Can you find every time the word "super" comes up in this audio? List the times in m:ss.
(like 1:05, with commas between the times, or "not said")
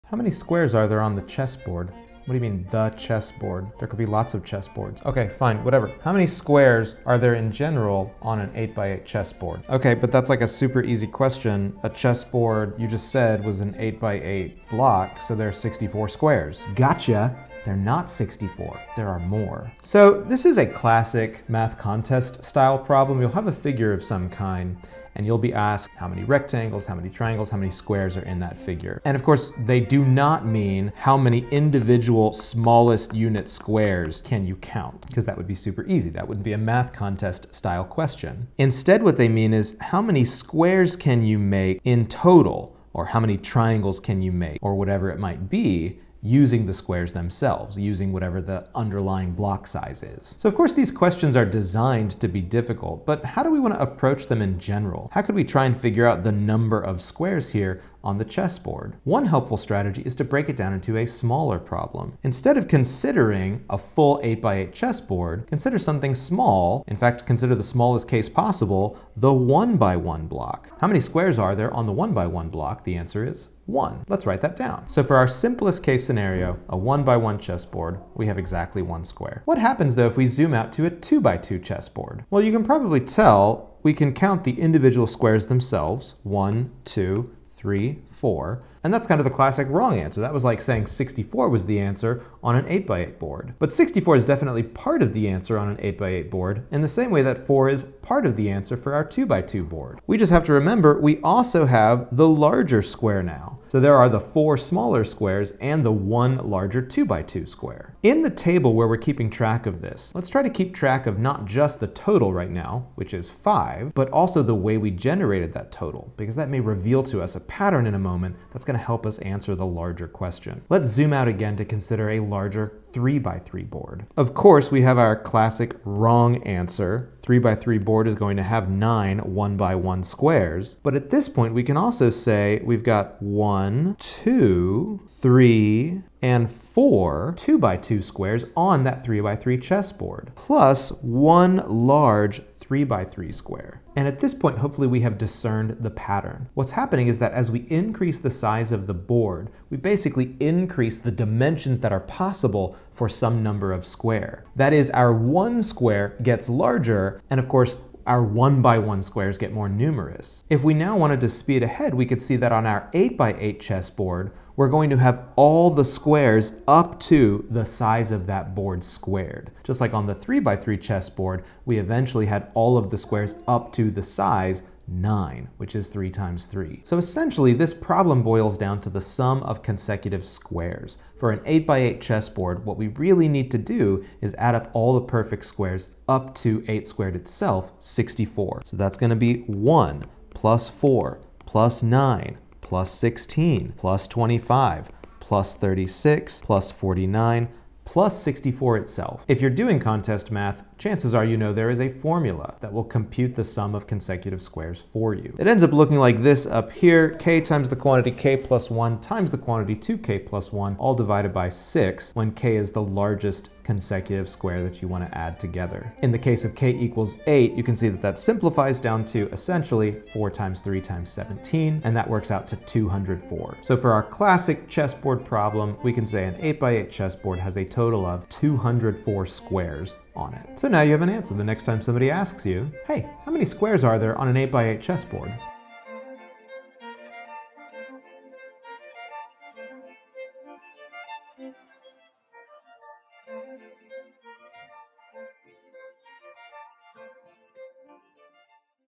0:10, 0:35.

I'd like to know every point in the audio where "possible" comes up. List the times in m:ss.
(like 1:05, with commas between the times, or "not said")
1:08, 2:31.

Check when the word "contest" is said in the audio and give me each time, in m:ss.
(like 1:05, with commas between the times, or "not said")
0:21, 0:36, 3:19.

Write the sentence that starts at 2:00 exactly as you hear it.
Let's zoom out again to consider a larger 3 by 3 board.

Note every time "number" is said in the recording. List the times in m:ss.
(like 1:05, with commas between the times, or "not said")
0:56, 2:33.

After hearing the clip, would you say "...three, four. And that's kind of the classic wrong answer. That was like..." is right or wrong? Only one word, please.
right.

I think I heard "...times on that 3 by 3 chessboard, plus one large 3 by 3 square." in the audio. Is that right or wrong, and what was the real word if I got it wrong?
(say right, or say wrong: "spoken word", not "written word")
wrong: "squares", not "times".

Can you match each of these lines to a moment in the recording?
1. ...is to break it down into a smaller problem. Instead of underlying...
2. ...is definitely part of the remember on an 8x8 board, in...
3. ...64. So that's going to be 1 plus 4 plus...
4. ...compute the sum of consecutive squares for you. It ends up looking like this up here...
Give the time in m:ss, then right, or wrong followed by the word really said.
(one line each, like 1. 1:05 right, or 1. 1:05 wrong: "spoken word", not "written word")
1. 1:00 wrong: "considering", not "underlying"
2. 1:34 wrong: "answer", not "remember"
3. 3:07 right
4. 3:22 right.